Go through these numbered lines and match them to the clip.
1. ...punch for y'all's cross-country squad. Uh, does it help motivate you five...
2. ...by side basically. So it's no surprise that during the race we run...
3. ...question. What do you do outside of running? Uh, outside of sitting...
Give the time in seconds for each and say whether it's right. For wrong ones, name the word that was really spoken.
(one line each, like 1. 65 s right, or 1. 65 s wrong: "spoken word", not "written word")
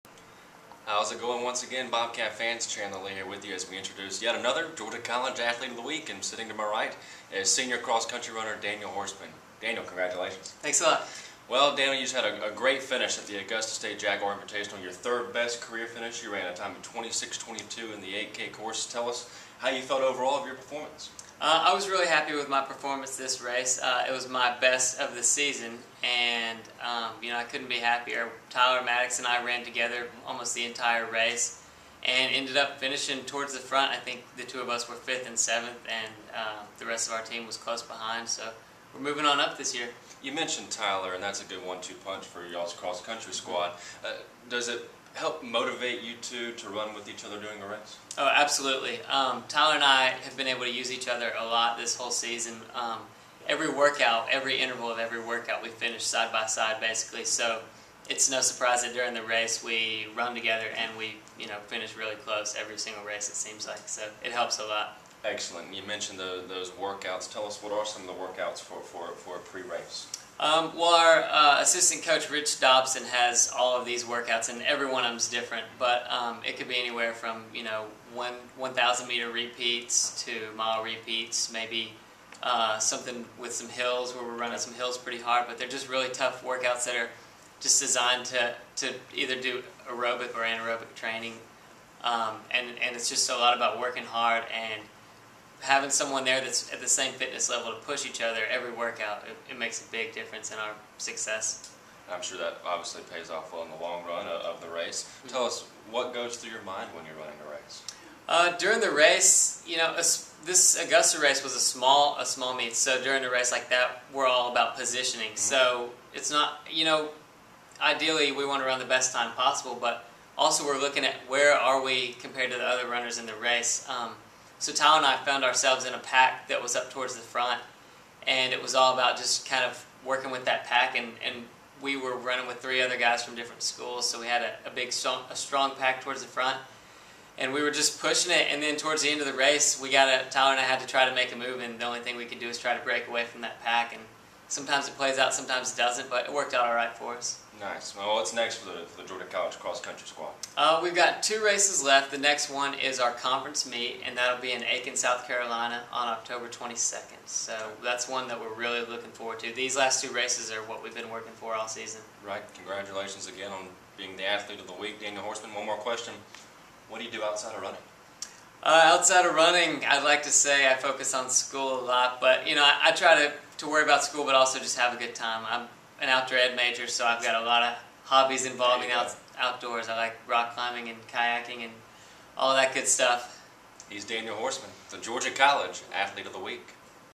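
1. 42 s wrong: "two", not "five"
2. 56 s right
3. 165 s wrong: "running", not "sitting".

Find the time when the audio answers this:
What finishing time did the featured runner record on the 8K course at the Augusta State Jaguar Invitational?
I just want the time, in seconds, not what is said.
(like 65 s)
16 s.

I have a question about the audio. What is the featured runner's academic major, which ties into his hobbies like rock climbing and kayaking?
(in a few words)
Outdoor ed.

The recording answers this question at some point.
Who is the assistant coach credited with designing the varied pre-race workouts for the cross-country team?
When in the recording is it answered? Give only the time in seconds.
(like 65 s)
72 s.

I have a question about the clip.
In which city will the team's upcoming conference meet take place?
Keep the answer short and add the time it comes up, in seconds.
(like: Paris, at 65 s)
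Aiken, South Carolina, at 154 s.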